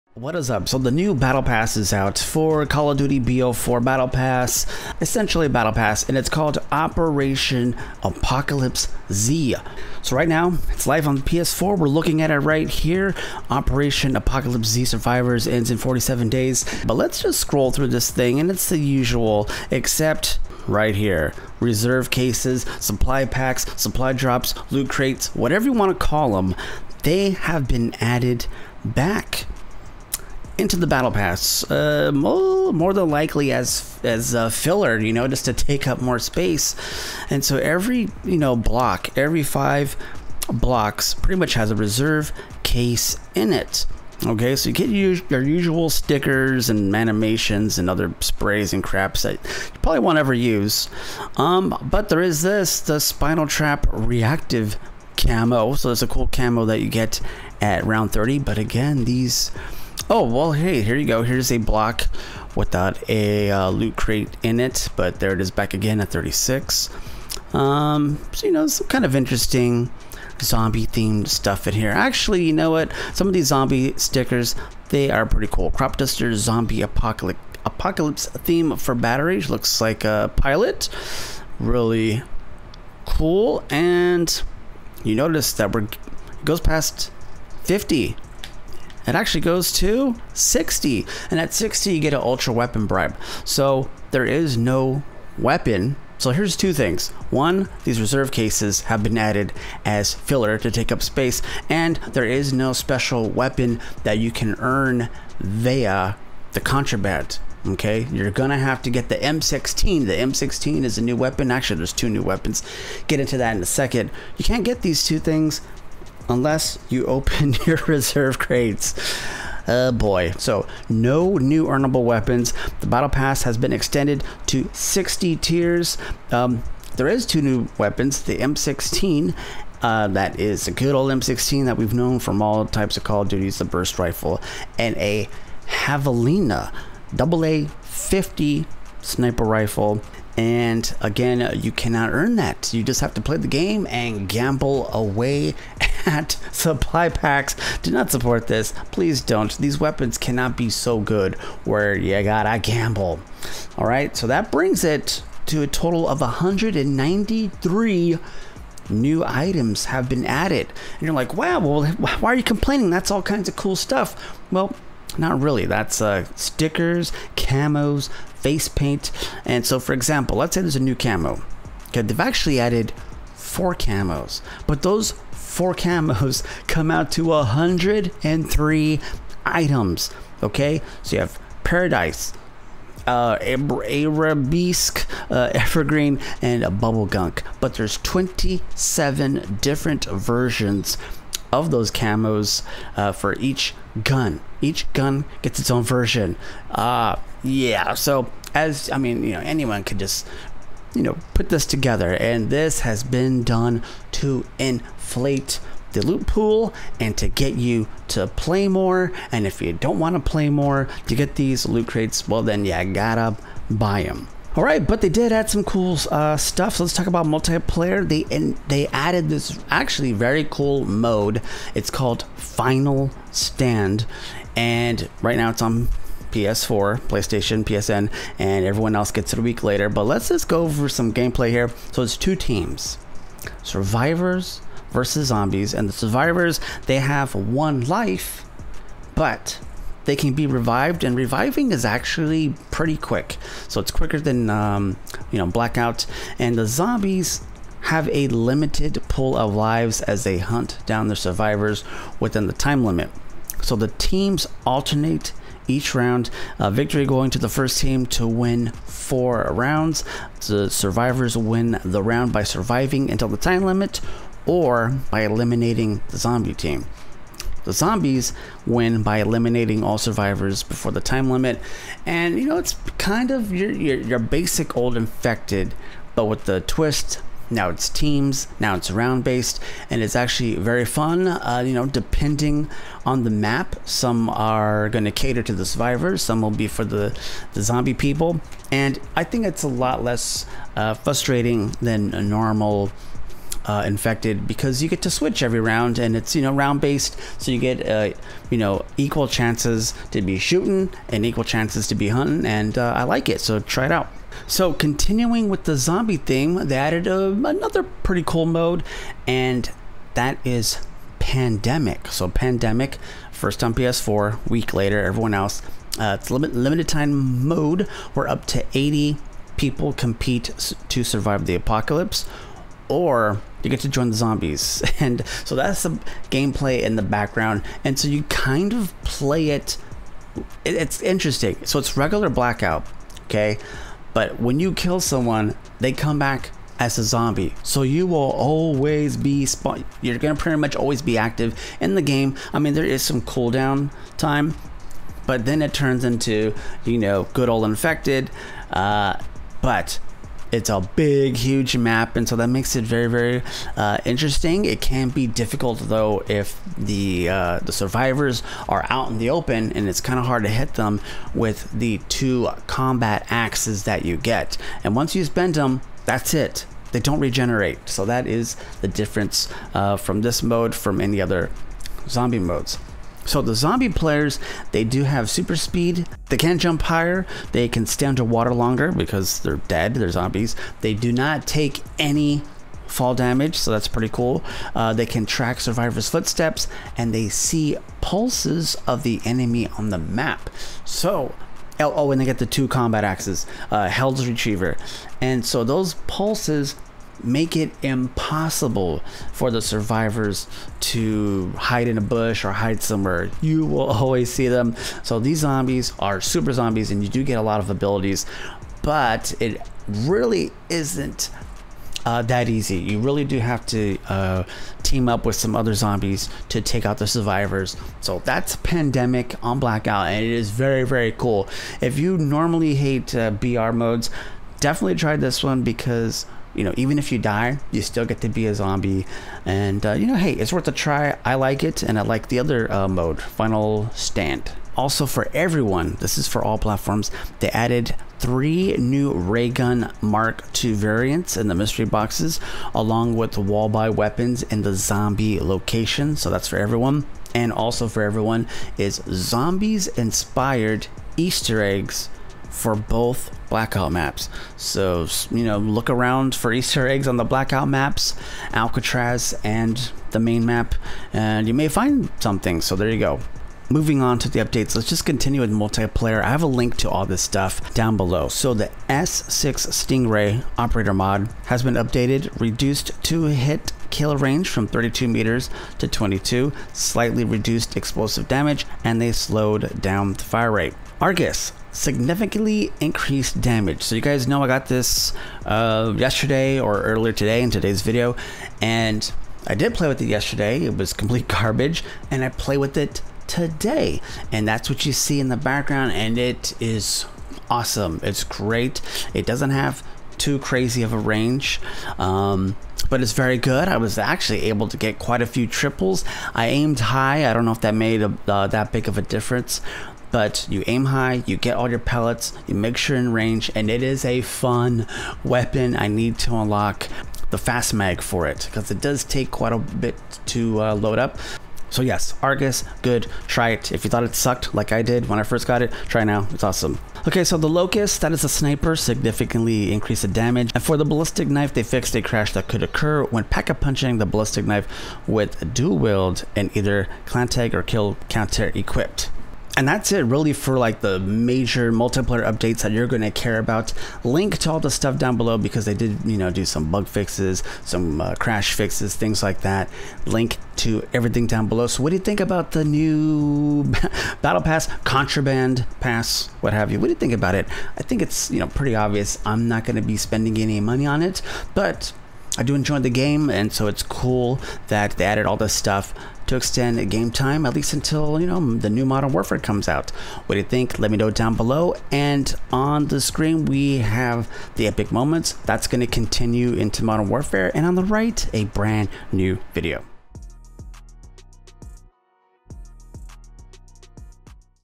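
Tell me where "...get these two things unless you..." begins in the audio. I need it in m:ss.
1:54.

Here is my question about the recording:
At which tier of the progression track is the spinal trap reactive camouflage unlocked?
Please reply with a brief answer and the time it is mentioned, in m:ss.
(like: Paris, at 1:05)
30, at 0:57.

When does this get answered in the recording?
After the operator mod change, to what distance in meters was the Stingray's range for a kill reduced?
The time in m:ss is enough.
7:55.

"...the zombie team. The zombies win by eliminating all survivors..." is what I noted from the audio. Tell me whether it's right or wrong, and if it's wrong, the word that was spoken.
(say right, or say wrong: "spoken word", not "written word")
right.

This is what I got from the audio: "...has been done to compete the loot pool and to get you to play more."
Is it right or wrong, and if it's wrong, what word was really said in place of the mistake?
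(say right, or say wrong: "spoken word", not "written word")
wrong: "inflate", not "compete".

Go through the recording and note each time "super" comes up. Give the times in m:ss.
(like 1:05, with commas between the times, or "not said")
6:15, 6:46.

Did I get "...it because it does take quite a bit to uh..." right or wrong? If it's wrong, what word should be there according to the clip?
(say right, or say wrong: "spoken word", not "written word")
right.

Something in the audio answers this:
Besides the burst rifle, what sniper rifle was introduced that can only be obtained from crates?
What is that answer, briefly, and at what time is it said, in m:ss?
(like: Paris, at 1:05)
Javelina, at 2:15.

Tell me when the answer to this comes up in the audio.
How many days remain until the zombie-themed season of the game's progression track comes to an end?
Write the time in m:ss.
0:15.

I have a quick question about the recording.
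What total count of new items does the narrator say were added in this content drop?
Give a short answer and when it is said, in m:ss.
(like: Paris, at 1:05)
193, at 2:36.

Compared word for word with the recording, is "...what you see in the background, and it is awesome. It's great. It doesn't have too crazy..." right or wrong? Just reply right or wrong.
right.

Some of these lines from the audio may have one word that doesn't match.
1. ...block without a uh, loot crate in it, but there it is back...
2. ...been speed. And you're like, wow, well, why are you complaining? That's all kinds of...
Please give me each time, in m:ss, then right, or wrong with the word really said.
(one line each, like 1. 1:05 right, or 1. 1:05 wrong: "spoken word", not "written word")
1. 1:01 right
2. 2:40 wrong: "added", not "speed".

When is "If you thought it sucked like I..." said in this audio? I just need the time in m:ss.
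8:43.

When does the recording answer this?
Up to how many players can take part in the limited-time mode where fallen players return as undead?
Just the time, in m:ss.
5:18.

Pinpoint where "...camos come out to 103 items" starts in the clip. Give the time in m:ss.
2:55.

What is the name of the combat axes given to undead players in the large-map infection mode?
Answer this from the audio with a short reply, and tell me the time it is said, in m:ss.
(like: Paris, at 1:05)
Hell's Retriever, at 6:33.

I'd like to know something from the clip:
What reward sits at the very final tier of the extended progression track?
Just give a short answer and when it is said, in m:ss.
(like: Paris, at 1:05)
Ultra weapon bribe, at 1:32.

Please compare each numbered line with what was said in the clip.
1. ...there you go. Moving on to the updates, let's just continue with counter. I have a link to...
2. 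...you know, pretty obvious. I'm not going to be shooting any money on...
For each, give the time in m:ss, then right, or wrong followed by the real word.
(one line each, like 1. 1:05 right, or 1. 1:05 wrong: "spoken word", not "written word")
1. 7:42 wrong: "multiplayer", not "counter"
2. 9:18 wrong: "spending", not "shooting".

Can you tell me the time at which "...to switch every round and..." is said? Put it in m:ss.
4:55.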